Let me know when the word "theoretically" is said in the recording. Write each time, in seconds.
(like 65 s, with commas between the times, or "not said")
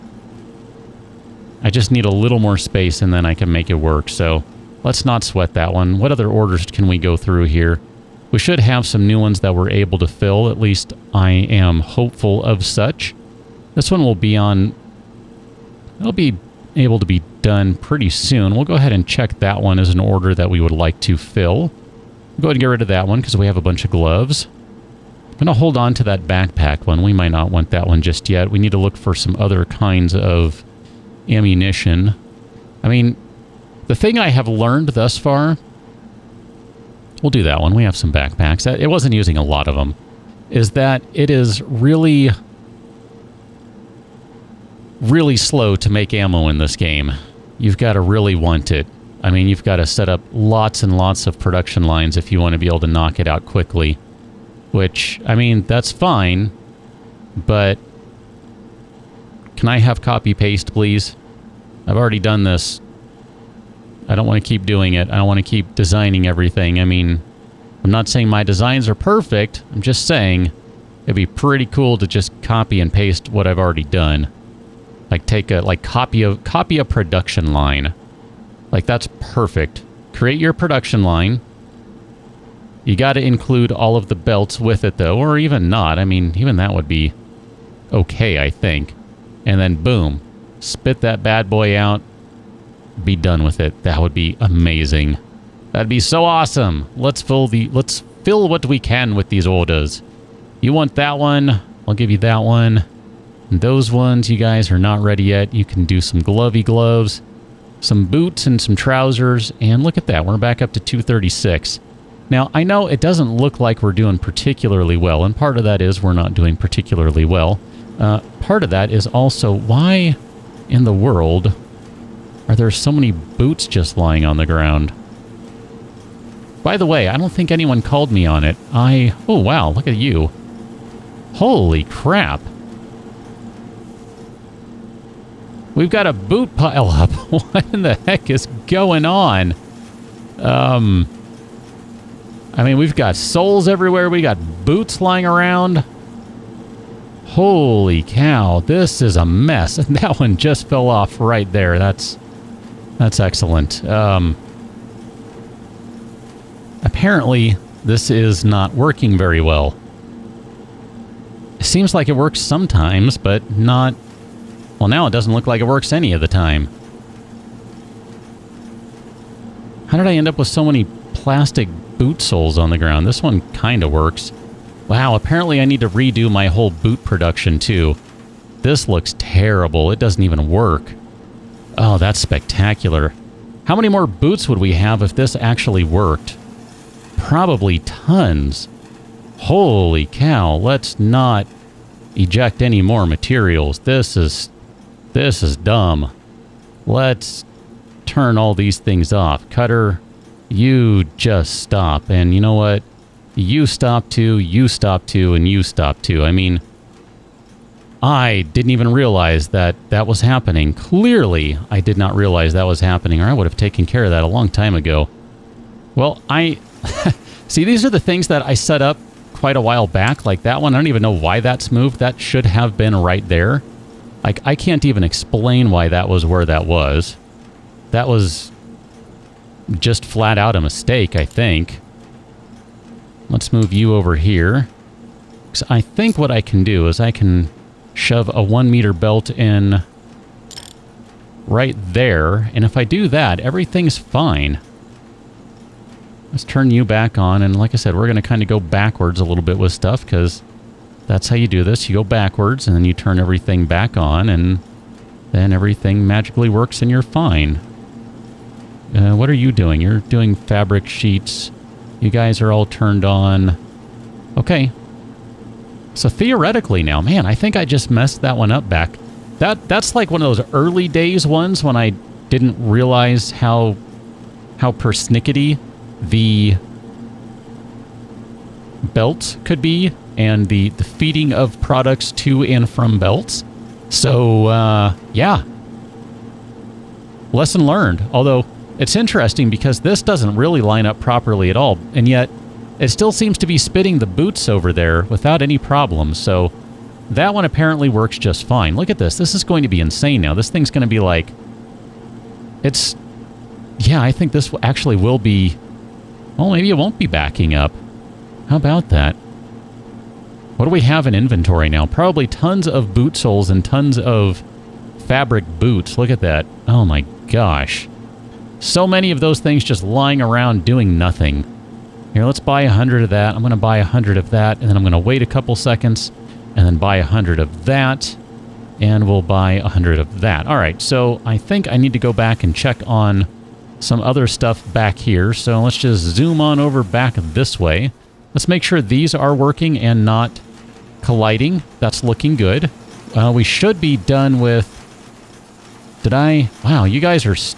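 266 s.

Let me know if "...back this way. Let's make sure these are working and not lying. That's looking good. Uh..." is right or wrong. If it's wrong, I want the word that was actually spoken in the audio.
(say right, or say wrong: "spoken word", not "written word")
wrong: "colliding", not "lying".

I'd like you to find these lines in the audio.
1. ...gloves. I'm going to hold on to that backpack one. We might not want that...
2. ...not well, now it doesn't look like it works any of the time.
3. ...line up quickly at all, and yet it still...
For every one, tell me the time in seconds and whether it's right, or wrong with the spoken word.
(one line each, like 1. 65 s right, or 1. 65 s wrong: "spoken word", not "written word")
1. 23 s right
2. 163 s right
3. 290 s wrong: "properly", not "quickly".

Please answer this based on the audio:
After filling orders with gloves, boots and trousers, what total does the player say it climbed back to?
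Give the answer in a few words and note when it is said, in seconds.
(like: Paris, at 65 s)
236, at 110 s.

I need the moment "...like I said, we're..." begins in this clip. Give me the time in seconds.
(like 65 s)
247 s.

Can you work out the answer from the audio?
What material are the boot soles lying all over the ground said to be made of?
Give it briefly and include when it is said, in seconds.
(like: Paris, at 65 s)
Plastic, at 171 s.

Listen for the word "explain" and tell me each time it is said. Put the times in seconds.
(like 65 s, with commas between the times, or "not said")
225 s.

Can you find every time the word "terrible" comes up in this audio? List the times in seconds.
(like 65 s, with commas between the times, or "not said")
179 s.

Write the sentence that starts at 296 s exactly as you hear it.
So, that one apparently works just fine.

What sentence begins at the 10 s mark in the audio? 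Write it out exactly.
At least I am hopeful of such.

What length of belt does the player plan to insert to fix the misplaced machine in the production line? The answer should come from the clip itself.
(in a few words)
1 meter.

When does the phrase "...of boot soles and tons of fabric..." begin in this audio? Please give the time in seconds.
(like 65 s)
312 s.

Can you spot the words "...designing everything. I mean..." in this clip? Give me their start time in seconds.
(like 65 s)
65 s.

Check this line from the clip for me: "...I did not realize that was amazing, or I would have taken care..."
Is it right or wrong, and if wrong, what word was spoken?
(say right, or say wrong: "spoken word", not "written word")
wrong: "happening", not "amazing".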